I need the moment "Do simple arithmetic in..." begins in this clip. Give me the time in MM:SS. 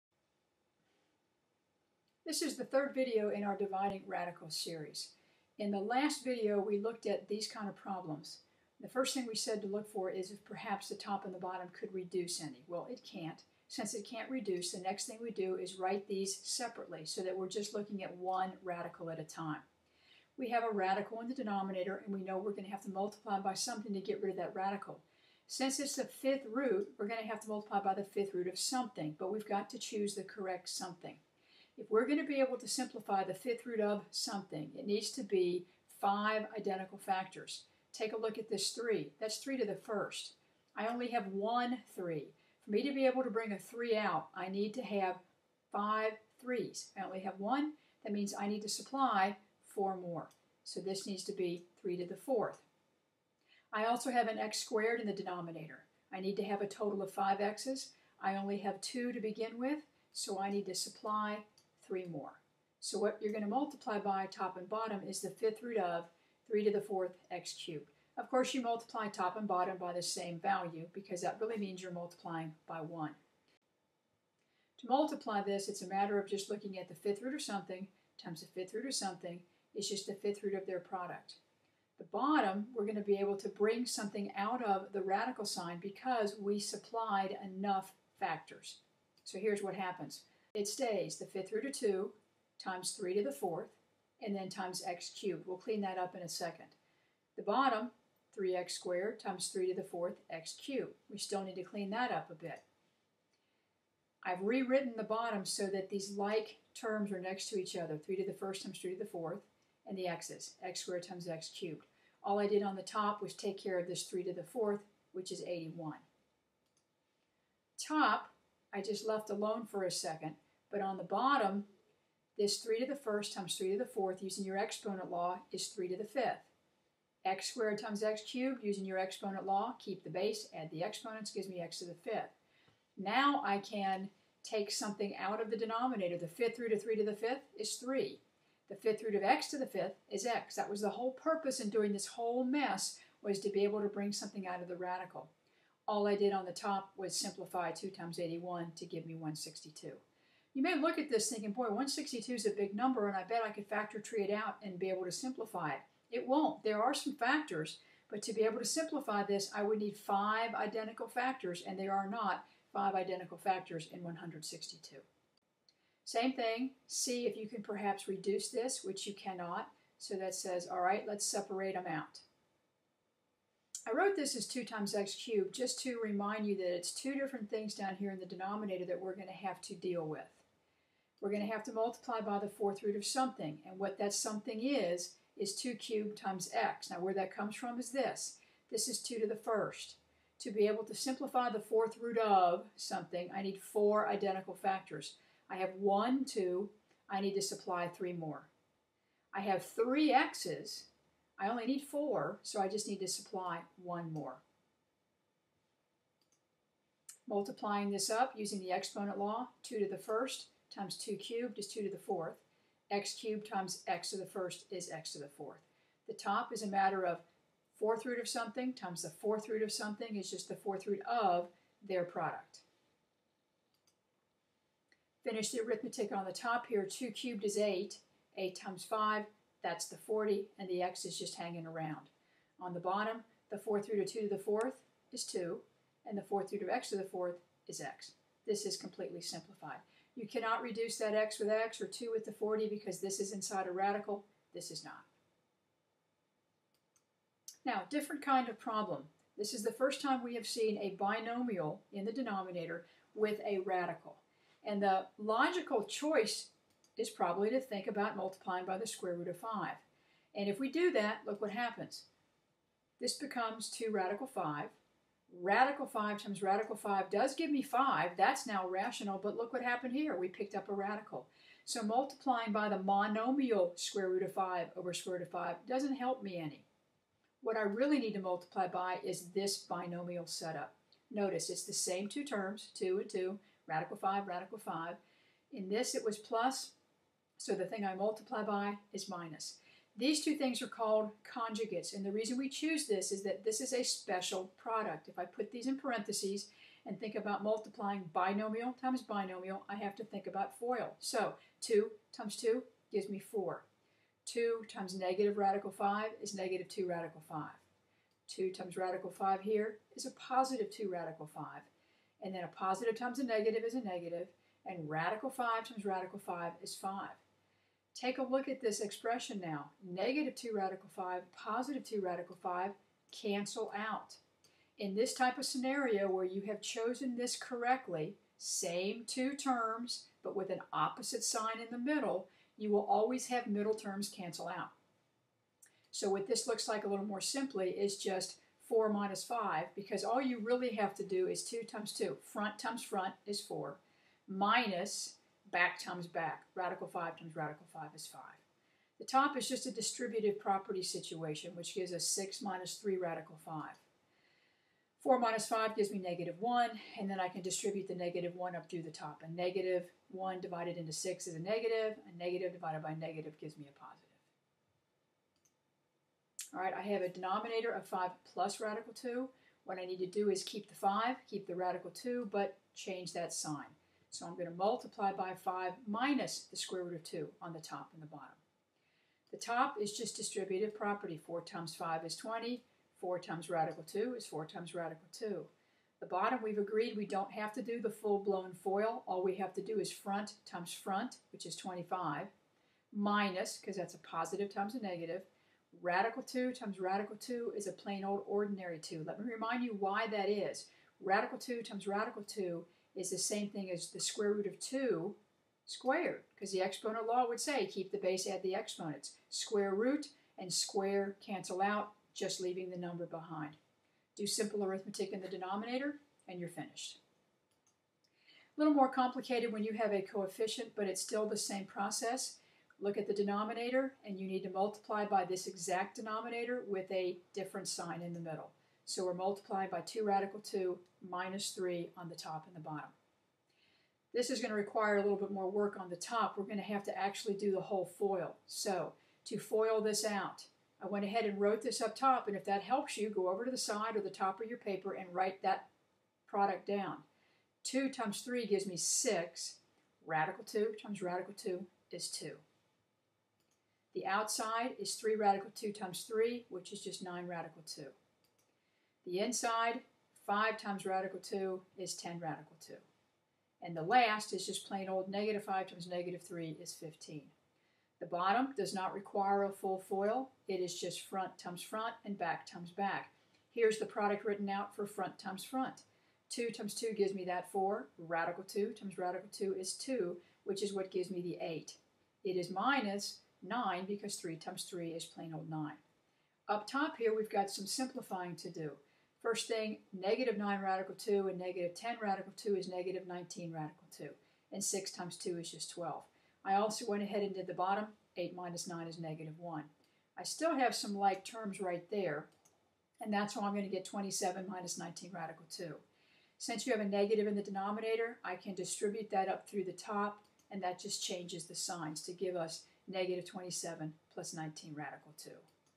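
06:54.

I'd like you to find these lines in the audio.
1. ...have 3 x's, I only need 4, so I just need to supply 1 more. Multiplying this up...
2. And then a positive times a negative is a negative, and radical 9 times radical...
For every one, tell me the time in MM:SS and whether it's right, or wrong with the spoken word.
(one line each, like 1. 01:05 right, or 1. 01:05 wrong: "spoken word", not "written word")
1. 03:19 right
2. 05:12 wrong: "5", not "9".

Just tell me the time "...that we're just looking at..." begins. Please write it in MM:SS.
00:17.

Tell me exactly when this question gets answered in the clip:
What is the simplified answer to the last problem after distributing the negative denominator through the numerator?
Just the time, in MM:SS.
08:32.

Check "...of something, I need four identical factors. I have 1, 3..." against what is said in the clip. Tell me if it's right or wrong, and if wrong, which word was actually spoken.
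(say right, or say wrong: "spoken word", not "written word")
wrong: "2", not "3".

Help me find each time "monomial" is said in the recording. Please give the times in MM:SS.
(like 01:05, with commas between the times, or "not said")
04:32.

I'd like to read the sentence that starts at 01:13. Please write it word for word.
To multiply this, it's a matter of just looking at the fifth root of something times the fifth root of something.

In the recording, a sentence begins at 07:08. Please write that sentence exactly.
So we're multiplying by 2 radical 2 minus 3 on the top and the bottom.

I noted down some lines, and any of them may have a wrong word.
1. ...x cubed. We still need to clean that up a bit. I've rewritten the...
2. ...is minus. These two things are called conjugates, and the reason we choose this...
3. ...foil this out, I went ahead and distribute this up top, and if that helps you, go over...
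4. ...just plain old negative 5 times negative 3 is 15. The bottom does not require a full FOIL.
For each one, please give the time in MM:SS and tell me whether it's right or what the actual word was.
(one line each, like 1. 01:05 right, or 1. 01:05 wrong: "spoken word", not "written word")
1. 01:40 right
2. 04:48 right
3. 07:19 wrong: "wrote", not "distribute"
4. 07:44 right.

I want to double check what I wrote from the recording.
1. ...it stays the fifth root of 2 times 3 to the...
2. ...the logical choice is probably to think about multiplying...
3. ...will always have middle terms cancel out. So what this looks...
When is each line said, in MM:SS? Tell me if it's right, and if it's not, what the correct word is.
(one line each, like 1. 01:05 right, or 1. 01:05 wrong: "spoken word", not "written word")
1. 01:30 right
2. 04:14 right
3. 05:32 right.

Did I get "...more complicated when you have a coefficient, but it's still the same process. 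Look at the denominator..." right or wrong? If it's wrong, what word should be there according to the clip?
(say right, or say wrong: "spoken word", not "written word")
right.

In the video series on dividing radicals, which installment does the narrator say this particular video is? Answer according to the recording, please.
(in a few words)
third.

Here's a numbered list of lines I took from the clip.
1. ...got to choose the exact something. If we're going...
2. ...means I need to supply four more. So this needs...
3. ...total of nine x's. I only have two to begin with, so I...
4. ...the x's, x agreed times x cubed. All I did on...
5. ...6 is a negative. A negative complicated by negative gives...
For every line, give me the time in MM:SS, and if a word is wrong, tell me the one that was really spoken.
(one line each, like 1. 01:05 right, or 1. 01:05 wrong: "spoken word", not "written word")
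1. 00:29 wrong: "correct", not "exact"
2. 00:48 right
3. 00:56 wrong: "five", not "nine"
4. 01:49 wrong: "squared", not "agreed"
5. 06:00 wrong: "divided", not "complicated".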